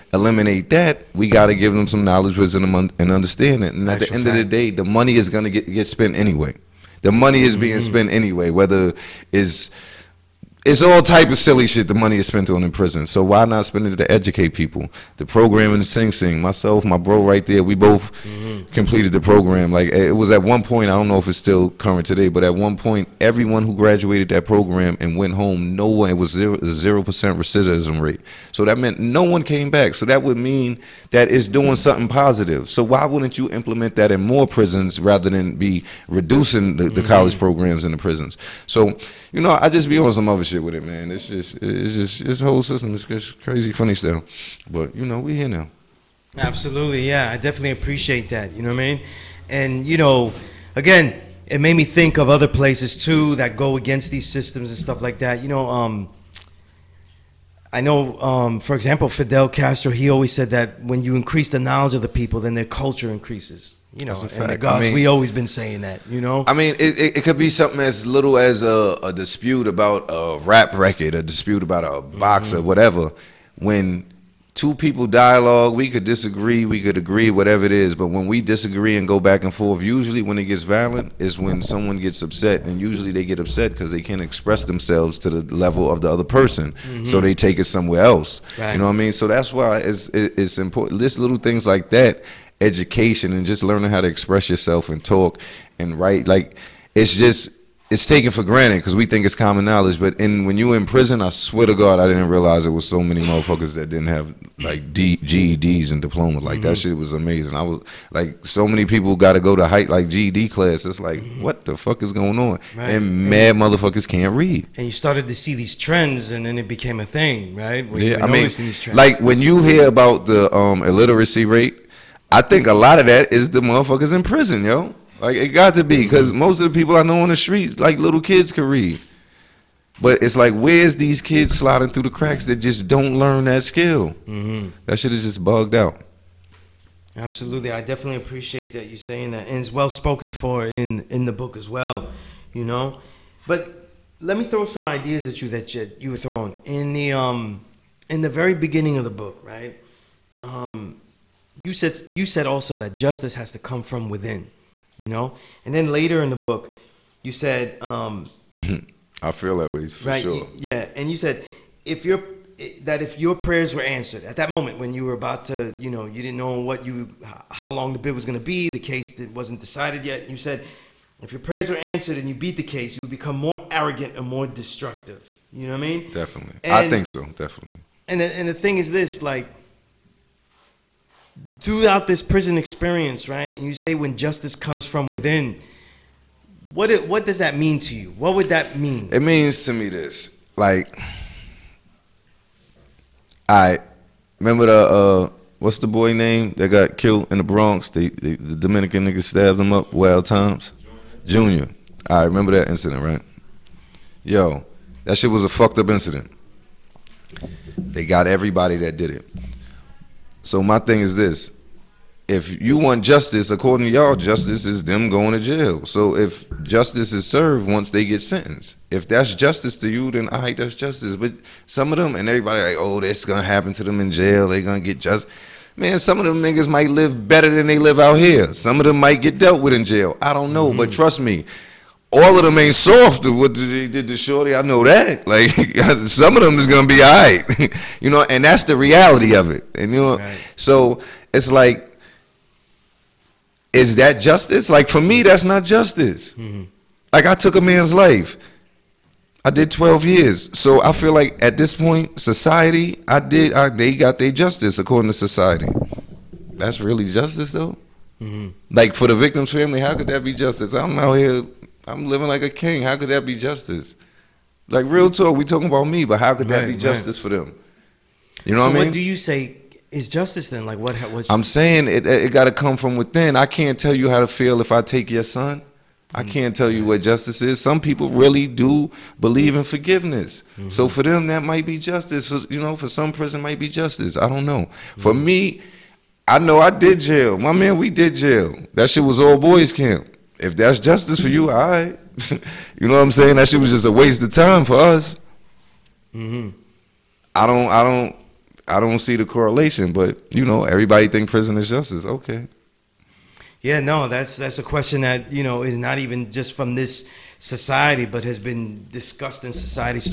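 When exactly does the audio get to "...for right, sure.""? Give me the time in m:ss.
2:39.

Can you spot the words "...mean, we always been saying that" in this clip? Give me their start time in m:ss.
1:04.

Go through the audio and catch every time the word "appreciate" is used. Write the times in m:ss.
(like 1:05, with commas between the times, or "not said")
0:47, 2:18.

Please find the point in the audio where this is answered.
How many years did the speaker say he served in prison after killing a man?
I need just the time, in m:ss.
4:09.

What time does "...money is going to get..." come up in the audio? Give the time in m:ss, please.
0:04.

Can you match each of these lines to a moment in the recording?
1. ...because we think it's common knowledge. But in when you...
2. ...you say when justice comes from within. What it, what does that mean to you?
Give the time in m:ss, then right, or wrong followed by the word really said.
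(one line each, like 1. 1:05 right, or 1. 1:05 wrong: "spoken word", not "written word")
1. 1:38 right
2. 3:03 right.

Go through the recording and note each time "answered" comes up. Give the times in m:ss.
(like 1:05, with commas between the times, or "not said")
2:43, 2:51.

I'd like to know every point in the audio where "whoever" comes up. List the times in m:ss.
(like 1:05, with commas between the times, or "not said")
not said.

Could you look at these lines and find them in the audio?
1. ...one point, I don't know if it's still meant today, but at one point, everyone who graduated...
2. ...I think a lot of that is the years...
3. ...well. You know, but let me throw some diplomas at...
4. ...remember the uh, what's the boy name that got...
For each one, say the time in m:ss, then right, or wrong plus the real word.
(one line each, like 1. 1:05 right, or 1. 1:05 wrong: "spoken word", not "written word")
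1. 0:20 wrong: "current", not "meant"
2. 2:02 wrong: "motherfuckers", not "years"
3. 2:21 wrong: "ideas", not "diplomas"
4. 3:14 right.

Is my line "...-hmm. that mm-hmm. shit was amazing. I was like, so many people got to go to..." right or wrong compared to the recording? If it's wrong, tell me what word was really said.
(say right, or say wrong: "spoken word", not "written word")
right.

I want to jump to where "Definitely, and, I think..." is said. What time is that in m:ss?
2:56.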